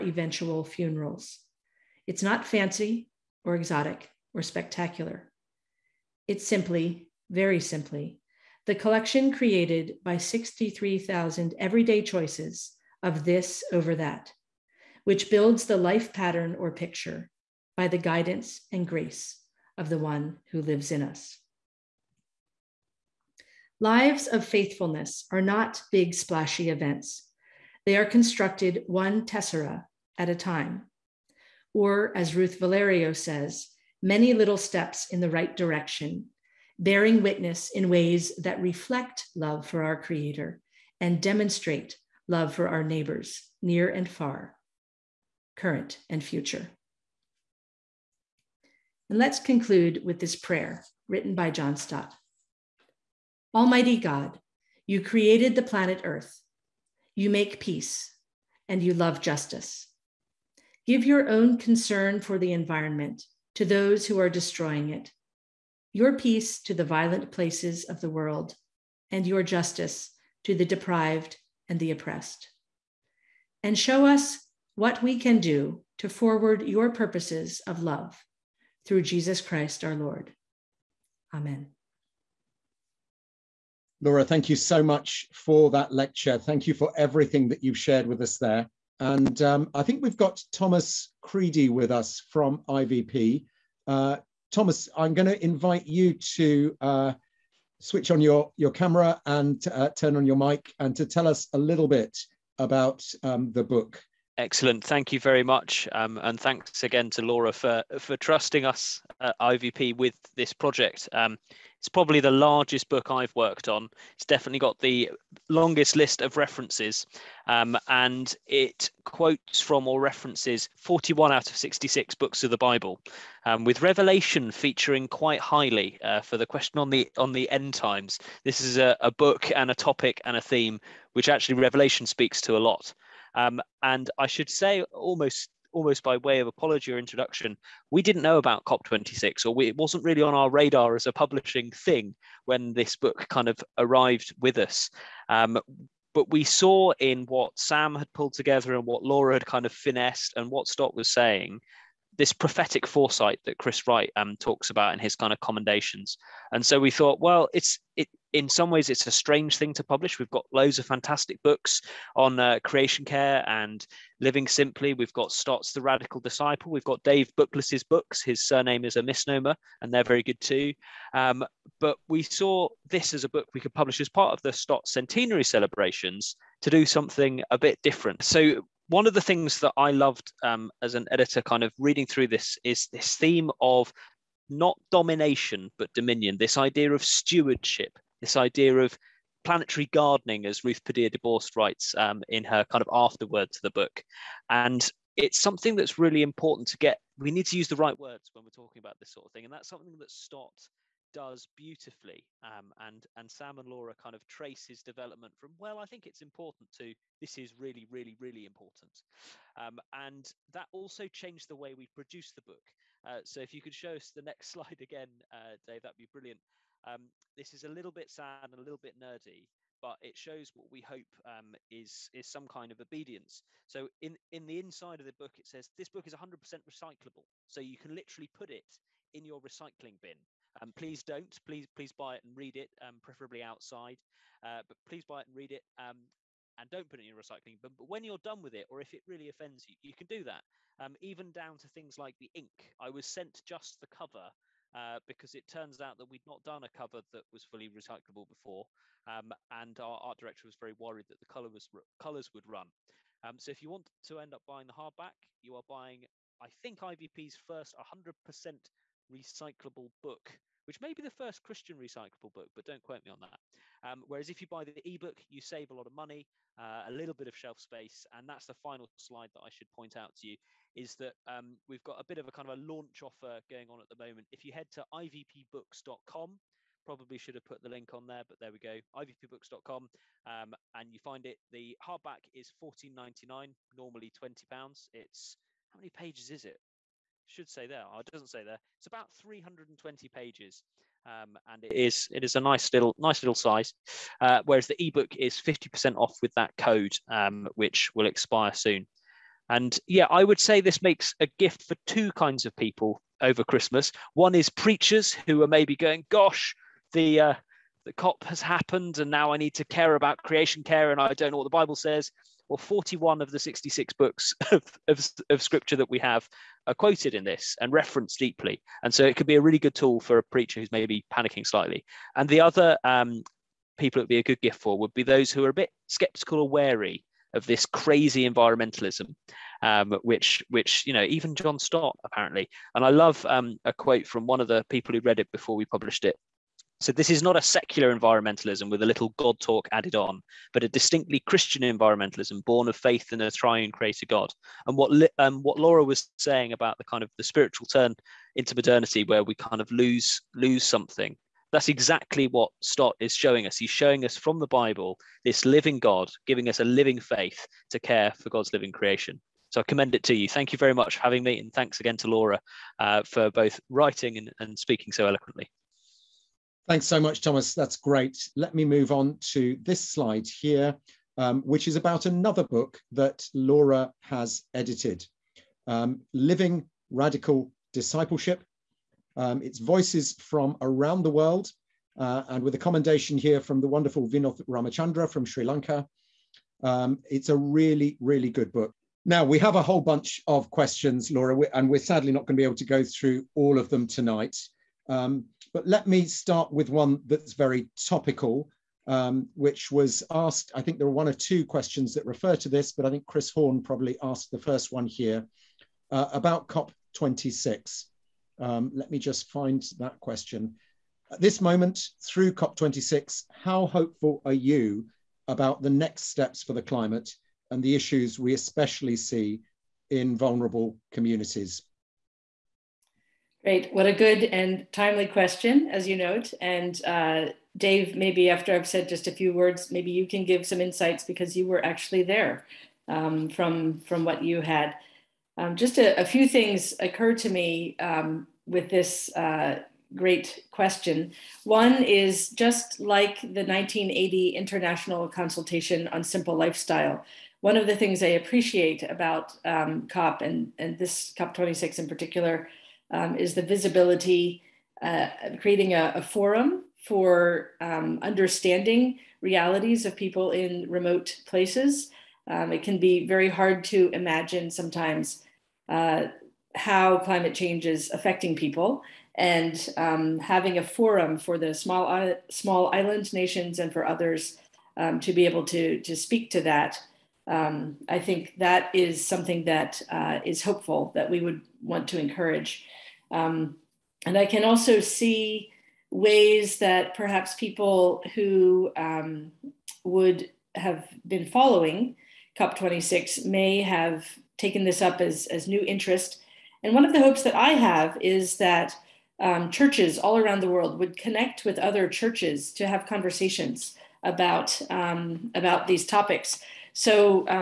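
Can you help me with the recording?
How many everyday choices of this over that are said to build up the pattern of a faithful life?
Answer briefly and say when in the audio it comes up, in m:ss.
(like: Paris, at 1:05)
63,000, at 0:10.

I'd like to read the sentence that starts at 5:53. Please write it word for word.
He's showing us from the Bible this living God, giving us a living faith to care for God's living creation.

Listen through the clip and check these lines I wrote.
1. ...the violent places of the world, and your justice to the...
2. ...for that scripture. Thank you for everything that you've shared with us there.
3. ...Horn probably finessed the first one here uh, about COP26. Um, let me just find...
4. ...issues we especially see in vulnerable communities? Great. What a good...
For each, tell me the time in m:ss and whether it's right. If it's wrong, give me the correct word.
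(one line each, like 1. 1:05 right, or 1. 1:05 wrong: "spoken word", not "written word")
1. 1:06 right
2. 1:25 wrong: "lecture", not "scripture"
3. 6:43 wrong: "asked", not "finessed"
4. 6:57 right.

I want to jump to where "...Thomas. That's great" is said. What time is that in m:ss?
6:07.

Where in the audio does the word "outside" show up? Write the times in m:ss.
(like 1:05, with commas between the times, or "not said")
3:53.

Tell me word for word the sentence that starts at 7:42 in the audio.
Um, it can be very hard to imagine sometimes uh, how climate change is affecting people.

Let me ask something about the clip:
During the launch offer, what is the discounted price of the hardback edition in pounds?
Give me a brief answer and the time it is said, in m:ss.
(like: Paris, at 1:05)
14.99, at 4:42.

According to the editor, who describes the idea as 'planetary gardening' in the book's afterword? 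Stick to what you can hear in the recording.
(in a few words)
Ruth Padilla DeBorst.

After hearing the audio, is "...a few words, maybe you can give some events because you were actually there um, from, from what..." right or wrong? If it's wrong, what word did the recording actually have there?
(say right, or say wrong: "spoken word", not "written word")
wrong: "insights", not "events".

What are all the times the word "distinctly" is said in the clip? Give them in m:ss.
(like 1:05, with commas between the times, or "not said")
5:40.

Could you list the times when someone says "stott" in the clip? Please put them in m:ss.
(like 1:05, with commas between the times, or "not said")
0:51, 2:30, 2:45, 2:54, 3:20, 5:31, 5:52.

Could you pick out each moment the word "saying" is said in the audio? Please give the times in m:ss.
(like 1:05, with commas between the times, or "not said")
2:31, 5:46.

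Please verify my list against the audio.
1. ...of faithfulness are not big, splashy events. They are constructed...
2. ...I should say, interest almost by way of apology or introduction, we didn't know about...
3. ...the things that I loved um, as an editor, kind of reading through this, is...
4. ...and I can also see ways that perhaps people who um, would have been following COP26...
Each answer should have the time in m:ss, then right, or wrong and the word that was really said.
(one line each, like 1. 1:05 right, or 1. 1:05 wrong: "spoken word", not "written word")
1. 0:24 right
2. 2:14 wrong: "almost", not "interest"
3. 2:59 right
4. 8:04 right.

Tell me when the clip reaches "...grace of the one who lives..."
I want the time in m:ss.
0:18.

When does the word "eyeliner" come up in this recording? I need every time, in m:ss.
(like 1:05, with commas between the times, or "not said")
not said.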